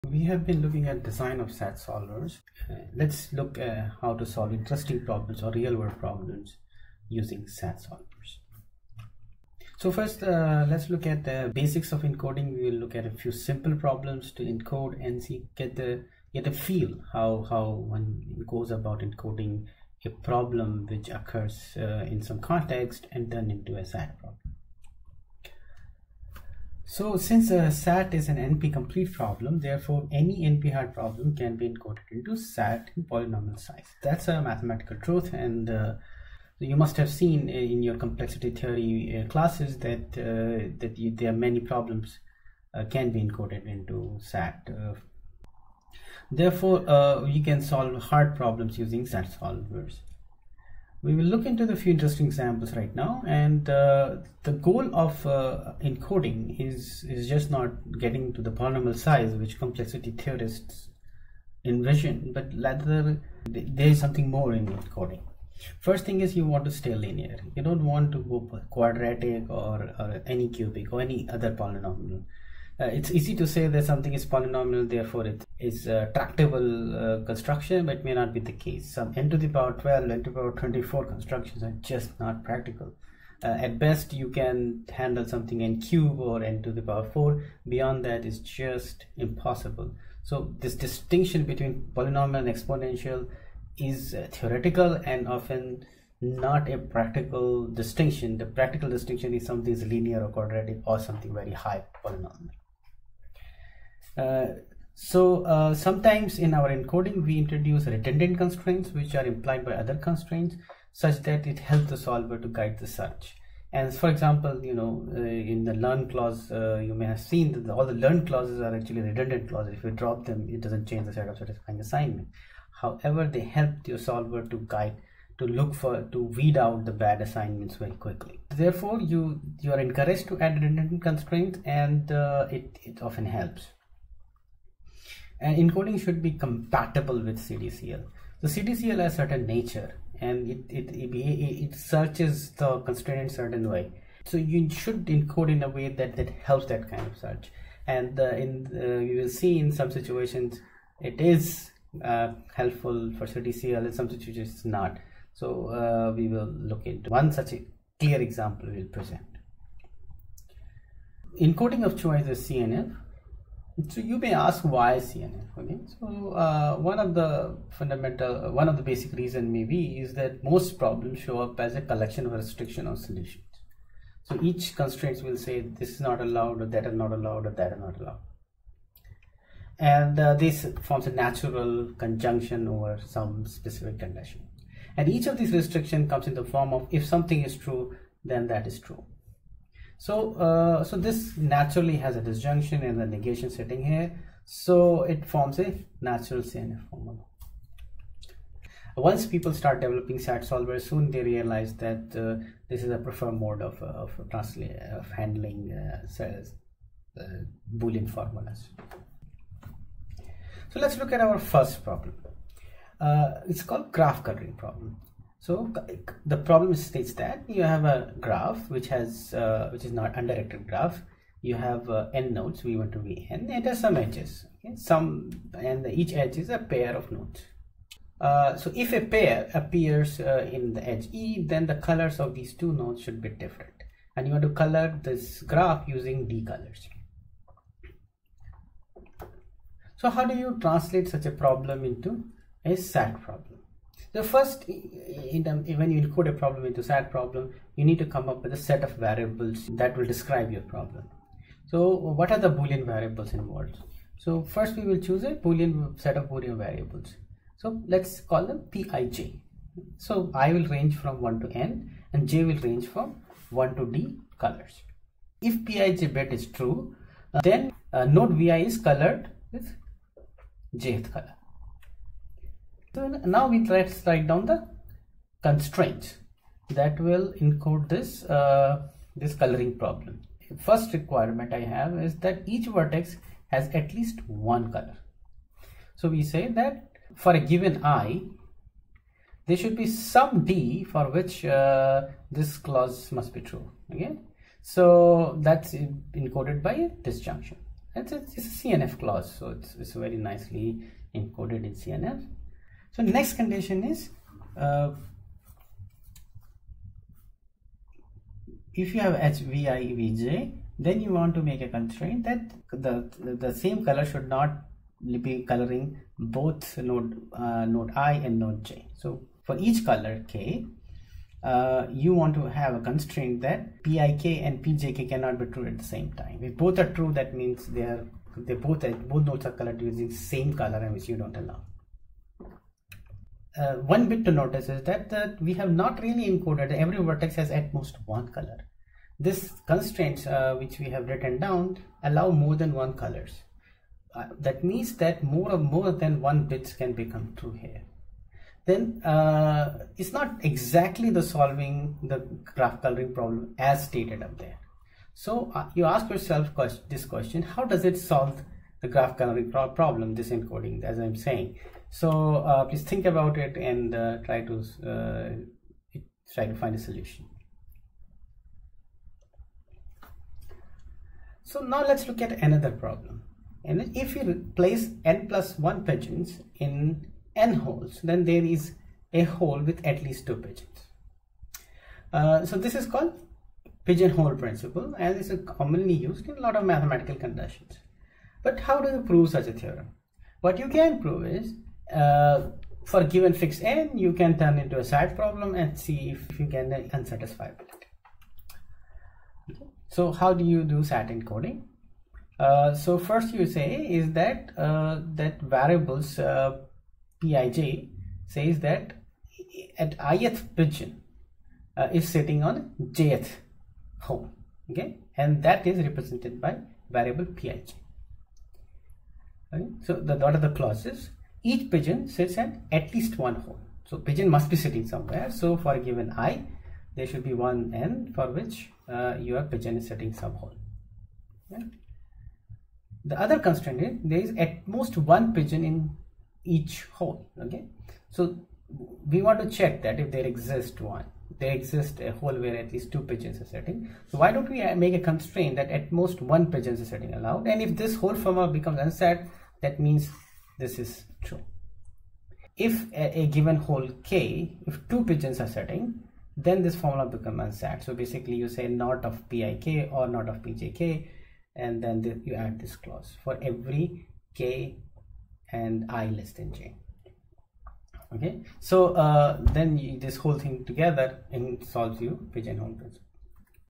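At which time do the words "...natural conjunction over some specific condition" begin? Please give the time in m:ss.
3:01.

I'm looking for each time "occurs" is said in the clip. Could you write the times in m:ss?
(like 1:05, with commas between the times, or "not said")
0:21.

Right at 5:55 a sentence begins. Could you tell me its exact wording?
So uh, you ask yourself this question, how does it solve the graph coloring pro problem, this encoding as I'm saying?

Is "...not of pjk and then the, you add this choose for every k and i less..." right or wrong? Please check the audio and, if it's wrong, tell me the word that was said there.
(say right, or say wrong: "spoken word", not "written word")
wrong: "clause", not "choose".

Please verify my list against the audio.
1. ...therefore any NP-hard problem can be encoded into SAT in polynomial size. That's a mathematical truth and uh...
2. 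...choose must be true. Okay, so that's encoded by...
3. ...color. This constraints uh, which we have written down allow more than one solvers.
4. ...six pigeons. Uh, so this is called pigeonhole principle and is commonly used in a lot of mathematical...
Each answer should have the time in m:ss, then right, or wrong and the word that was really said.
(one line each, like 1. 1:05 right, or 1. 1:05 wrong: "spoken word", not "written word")
1. 0:29 right
2. 4:52 wrong: "clause", not "choose"
3. 5:38 wrong: "colors", not "solvers"
4. 6:20 wrong: "two", not "six".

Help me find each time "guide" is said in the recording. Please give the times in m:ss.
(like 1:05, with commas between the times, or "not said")
1:52, 2:04.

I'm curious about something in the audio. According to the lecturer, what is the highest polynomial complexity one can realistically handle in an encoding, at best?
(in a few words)
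n^4.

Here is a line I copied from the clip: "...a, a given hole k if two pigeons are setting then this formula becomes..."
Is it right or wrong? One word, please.
right.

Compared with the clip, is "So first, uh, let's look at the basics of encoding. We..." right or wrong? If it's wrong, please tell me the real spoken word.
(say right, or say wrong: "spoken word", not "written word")
right.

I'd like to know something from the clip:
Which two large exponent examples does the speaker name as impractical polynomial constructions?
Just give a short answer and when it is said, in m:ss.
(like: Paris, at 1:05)
n^12 and n^24, at 1:19.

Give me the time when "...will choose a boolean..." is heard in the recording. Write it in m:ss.
4:14.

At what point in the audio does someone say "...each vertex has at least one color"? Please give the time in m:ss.
4:42.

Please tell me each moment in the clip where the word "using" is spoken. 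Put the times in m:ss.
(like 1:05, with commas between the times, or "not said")
0:07, 0:48, 3:55, 5:29.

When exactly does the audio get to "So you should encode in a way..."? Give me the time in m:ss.
2:24.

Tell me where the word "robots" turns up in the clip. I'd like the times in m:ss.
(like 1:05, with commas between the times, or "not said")
not said.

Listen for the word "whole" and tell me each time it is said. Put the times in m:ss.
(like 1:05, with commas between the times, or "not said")
7:27, 7:50.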